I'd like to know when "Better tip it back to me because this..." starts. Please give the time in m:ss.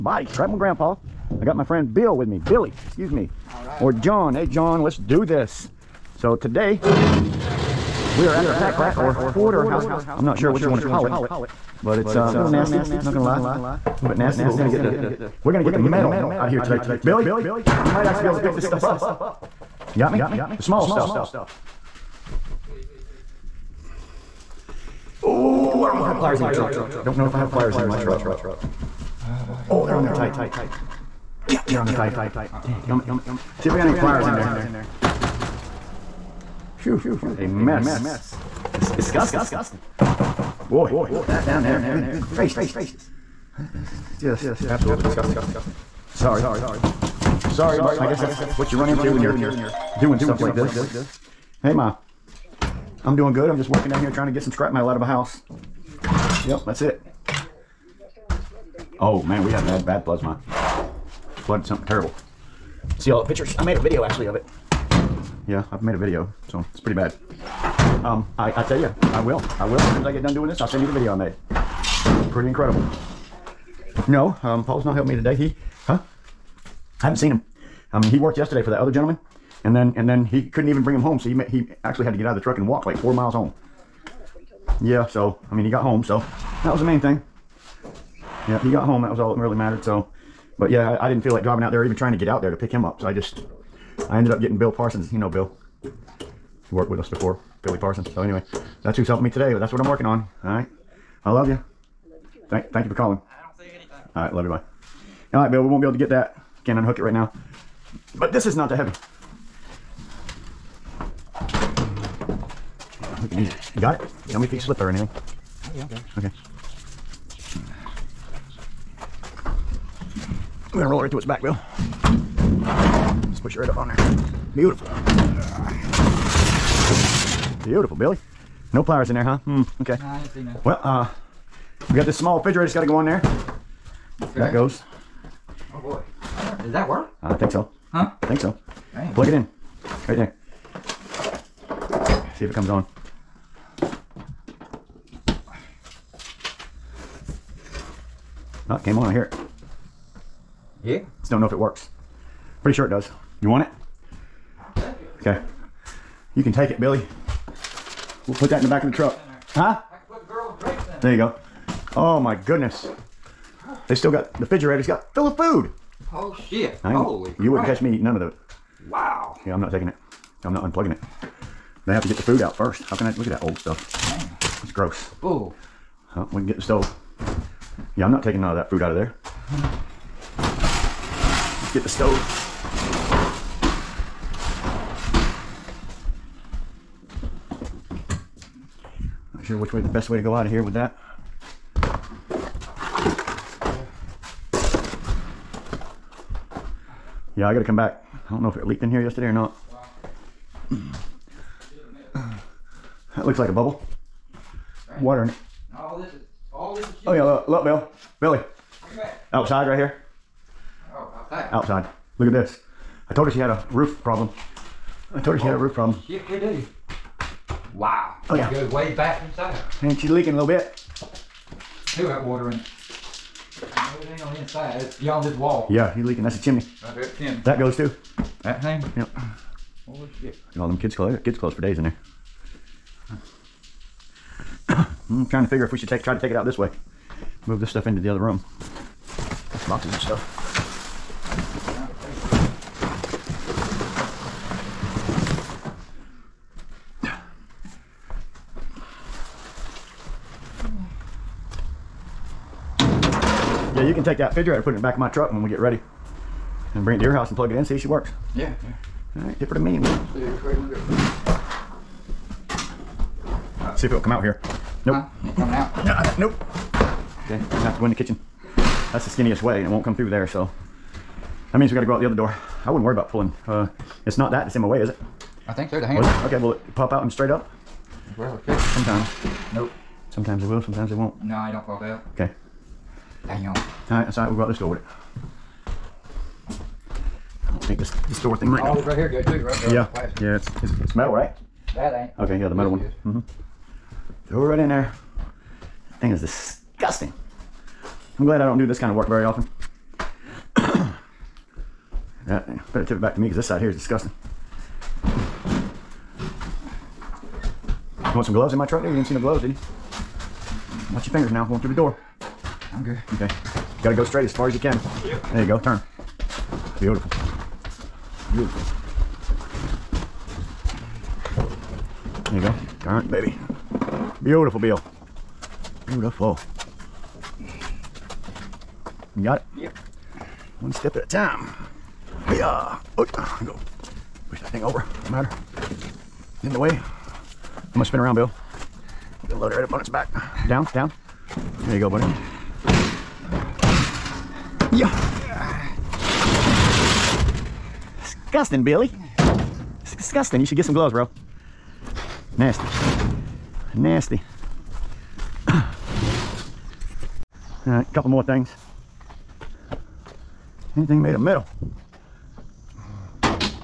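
5:02.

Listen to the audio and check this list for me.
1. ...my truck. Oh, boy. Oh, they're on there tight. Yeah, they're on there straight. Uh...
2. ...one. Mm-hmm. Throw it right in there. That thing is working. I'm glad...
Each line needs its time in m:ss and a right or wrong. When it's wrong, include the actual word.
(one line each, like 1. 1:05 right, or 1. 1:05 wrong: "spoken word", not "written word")
1. 0:27 wrong: "tight", not "straight"
2. 4:52 wrong: "disgusting", not "working".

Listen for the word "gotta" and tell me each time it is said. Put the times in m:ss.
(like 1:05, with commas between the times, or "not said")
3:17, 4:31.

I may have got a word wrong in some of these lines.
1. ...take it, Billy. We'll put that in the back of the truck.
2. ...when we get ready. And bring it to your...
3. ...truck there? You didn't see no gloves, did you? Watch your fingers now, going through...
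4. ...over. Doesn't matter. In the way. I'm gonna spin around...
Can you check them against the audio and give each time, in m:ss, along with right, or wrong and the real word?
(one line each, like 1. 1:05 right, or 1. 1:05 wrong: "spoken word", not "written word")
1. 2:36 right
2. 4:15 right
3. 5:08 right
4. 5:34 right.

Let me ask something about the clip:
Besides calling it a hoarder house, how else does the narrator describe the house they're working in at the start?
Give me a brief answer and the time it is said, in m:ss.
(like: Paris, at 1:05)
pack rat, at 0:08.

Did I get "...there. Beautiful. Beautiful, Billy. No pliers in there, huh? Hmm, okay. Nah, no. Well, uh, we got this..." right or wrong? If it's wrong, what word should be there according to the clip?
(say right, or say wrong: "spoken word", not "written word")
right.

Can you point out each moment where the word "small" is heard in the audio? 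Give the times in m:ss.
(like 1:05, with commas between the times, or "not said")
0:20, 2:12.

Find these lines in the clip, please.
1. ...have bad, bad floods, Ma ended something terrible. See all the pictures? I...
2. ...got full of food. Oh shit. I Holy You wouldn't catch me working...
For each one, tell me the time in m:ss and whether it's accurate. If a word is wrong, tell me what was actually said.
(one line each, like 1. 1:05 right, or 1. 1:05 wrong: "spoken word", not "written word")
1. 0:59 wrong: "flooded", not "ended"
2. 2:44 wrong: "eating", not "working".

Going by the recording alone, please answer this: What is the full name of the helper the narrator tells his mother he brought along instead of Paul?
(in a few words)
Bill Parsons.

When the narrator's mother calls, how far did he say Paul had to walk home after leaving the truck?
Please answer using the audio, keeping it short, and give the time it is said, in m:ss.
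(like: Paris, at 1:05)
4 miles, at 1:22.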